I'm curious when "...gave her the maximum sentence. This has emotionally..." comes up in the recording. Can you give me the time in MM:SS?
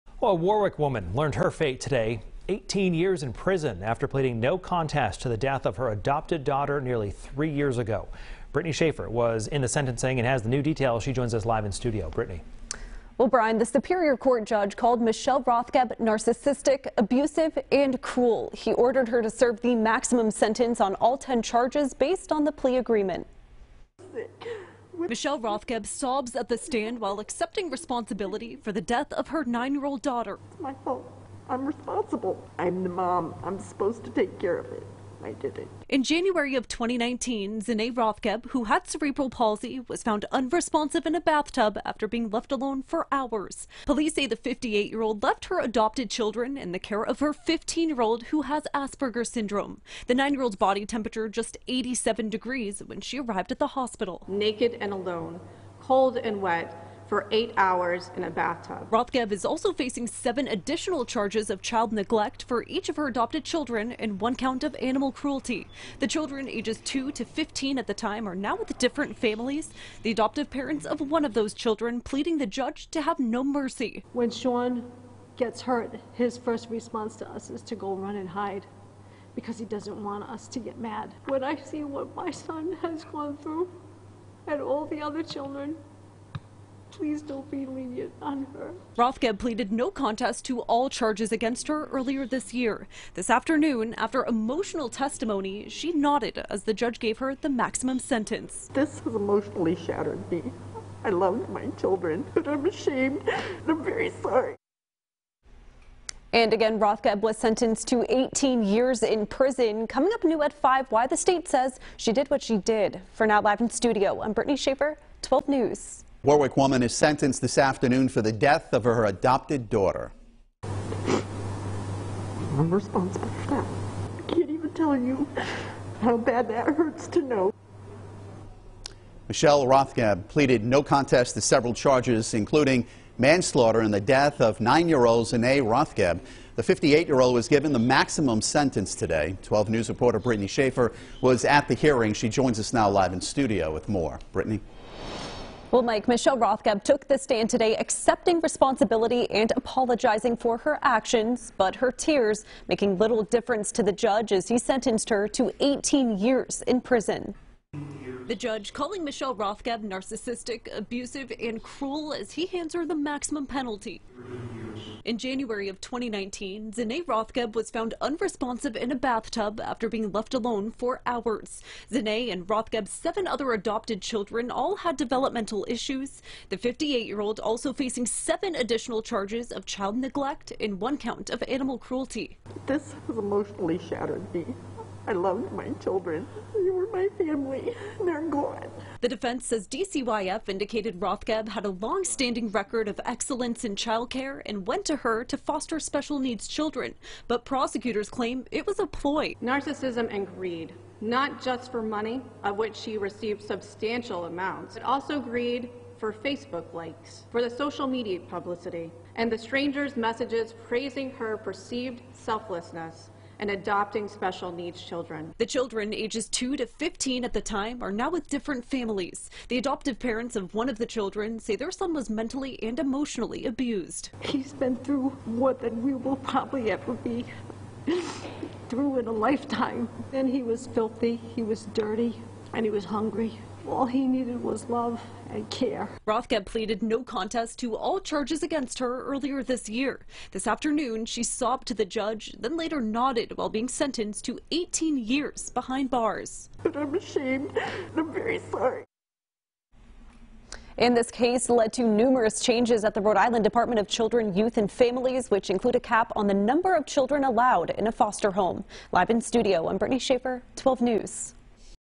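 01:36.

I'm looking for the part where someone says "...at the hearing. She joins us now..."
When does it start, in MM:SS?
02:21.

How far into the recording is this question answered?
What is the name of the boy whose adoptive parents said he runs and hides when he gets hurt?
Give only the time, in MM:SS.
01:14.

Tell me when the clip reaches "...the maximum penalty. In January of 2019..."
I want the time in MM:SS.
02:42.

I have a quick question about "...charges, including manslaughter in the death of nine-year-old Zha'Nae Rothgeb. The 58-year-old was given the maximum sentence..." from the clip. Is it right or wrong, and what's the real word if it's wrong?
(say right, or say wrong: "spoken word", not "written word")
right.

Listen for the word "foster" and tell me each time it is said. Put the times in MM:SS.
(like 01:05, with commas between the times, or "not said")
03:15, 04:17.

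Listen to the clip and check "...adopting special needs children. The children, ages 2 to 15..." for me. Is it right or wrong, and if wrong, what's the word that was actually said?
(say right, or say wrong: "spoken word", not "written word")
right.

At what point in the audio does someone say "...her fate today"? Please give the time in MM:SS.
00:01.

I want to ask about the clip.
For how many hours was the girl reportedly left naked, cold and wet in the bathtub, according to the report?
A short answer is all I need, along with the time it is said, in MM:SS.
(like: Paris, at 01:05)
8 hours, at 00:57.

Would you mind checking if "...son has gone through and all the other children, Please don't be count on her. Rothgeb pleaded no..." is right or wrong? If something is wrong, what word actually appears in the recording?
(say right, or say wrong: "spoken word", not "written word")
wrong: "lenient", not "count".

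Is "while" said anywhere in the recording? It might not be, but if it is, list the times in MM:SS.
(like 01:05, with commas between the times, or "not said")
00:27, 04:03.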